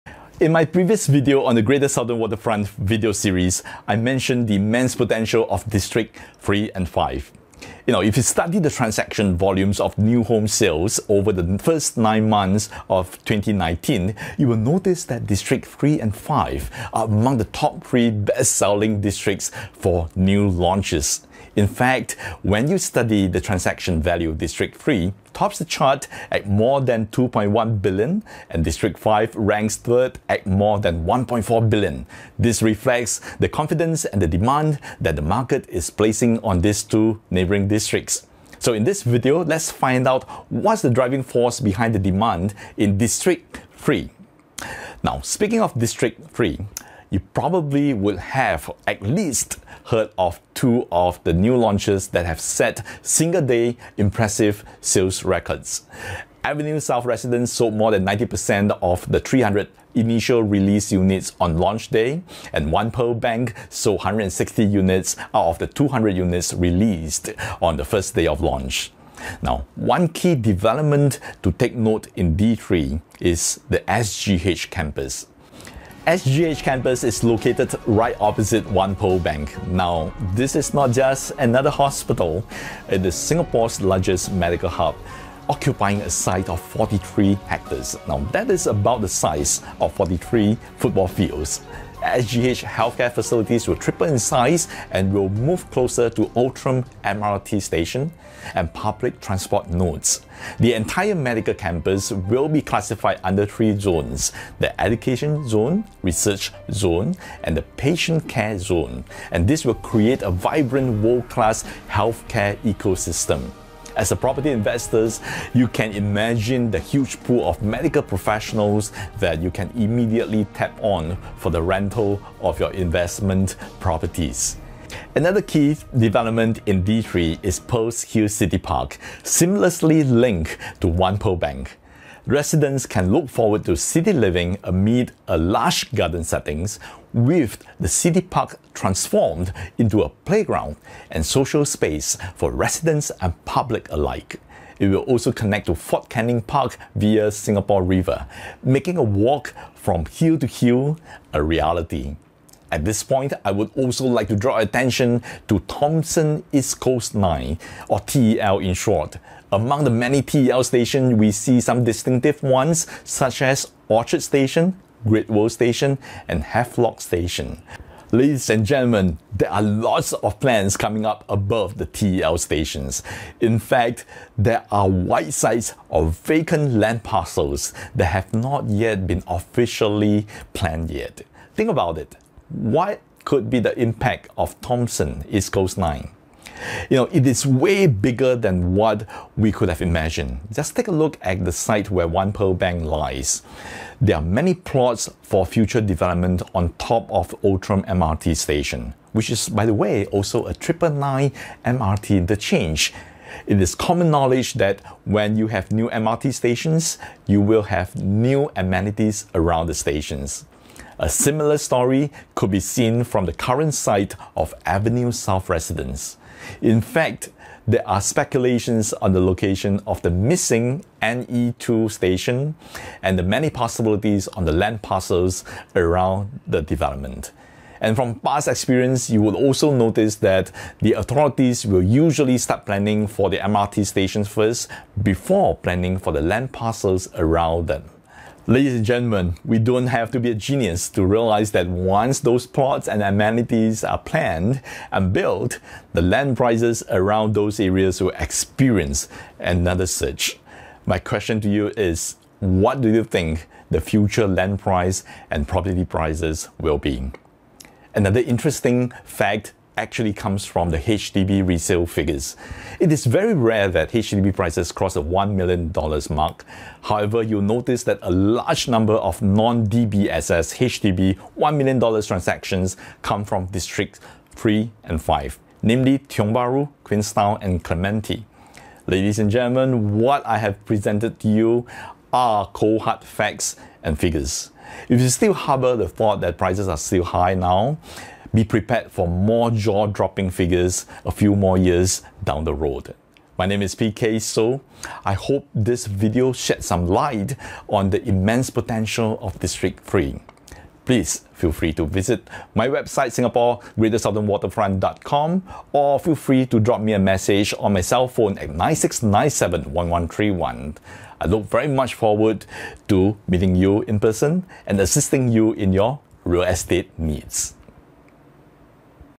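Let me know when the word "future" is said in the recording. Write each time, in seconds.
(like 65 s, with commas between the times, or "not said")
195 s, 253 s.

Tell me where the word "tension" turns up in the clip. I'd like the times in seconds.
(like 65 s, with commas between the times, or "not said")
not said.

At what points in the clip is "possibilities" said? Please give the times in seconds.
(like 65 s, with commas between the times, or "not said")
223 s.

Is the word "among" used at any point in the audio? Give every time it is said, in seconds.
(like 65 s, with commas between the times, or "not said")
17 s, 159 s.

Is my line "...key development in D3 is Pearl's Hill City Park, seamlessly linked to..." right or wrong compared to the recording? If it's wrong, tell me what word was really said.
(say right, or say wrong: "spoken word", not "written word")
right.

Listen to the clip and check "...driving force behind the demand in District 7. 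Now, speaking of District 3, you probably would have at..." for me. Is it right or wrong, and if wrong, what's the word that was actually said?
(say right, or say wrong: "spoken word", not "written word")
wrong: "3", not "7".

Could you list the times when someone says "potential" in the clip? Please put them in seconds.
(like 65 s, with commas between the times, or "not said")
4 s, 298 s.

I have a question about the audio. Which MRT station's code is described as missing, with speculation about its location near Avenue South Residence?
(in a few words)
NE2.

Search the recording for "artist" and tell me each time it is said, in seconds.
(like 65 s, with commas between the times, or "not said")
not said.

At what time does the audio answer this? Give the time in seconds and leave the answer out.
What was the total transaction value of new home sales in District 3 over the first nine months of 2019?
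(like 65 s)
26 s.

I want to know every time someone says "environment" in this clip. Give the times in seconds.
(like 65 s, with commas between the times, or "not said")
not said.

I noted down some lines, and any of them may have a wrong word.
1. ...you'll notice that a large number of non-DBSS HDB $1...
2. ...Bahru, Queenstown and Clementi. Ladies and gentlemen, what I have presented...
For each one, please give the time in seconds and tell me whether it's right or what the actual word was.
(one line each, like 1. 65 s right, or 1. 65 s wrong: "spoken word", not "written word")
1. 267 s right
2. 276 s right.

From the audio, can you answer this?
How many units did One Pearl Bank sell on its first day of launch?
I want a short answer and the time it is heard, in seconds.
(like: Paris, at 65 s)
160, at 63 s.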